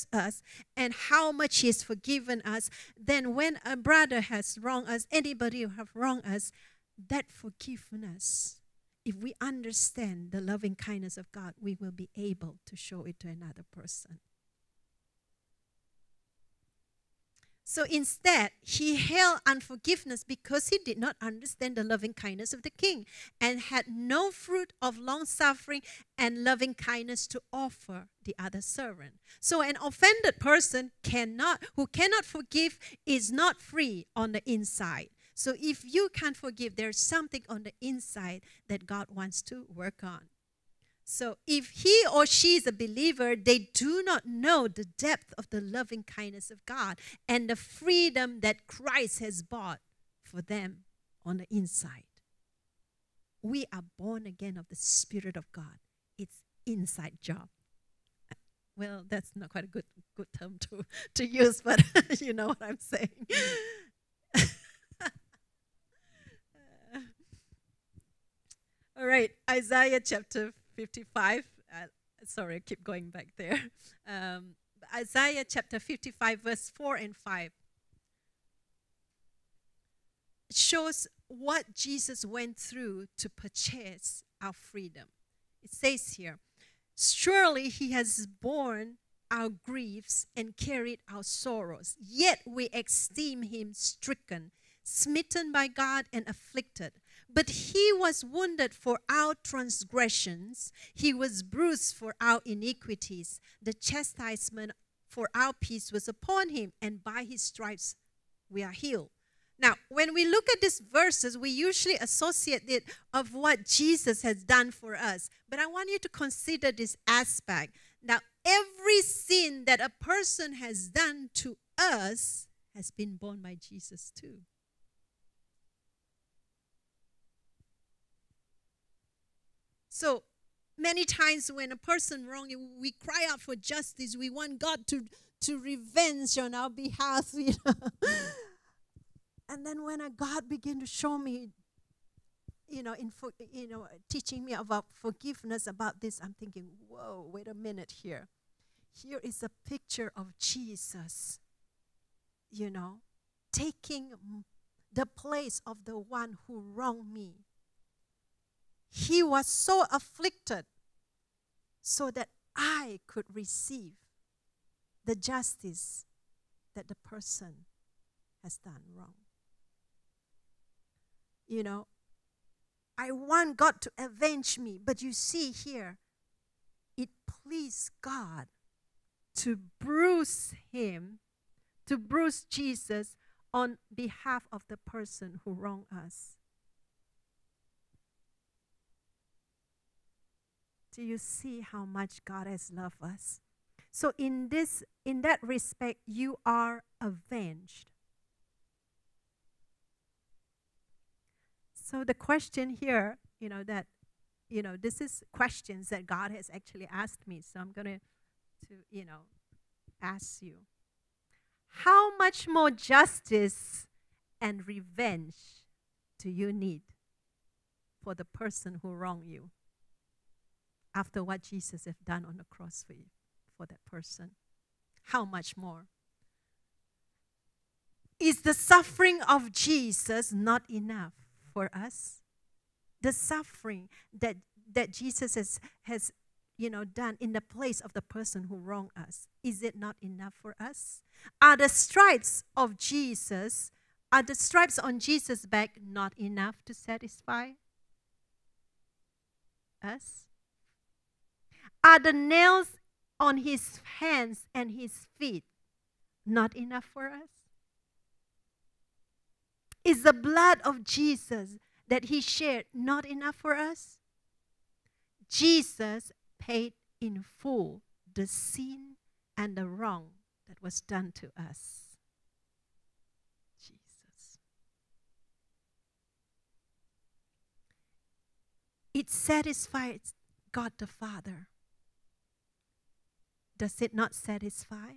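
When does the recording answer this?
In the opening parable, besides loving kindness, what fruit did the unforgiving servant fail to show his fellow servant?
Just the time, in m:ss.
0:24.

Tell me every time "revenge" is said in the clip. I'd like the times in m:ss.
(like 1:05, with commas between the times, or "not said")
2:15, 3:34.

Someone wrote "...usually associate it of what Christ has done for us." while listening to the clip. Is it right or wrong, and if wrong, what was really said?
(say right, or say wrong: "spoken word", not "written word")
wrong: "Jesus", not "Christ".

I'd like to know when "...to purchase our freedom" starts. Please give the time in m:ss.
1:23.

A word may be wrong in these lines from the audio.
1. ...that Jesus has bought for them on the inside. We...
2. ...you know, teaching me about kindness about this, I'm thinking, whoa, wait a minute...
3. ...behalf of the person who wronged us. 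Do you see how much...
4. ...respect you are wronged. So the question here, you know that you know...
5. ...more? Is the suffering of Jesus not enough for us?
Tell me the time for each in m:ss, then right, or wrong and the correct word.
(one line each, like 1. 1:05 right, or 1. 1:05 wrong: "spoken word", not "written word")
1. 0:48 wrong: "Christ", not "Jesus"
2. 2:23 wrong: "forgiveness", not "kindness"
3. 3:03 right
4. 3:15 wrong: "avenged", not "wronged"
5. 3:45 right.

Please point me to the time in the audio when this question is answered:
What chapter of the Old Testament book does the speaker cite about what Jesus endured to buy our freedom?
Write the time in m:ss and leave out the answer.
1:14.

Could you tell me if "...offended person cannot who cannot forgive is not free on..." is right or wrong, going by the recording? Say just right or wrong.
right.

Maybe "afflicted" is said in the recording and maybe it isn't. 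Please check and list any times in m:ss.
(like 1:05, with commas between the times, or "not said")
1:36, 2:39.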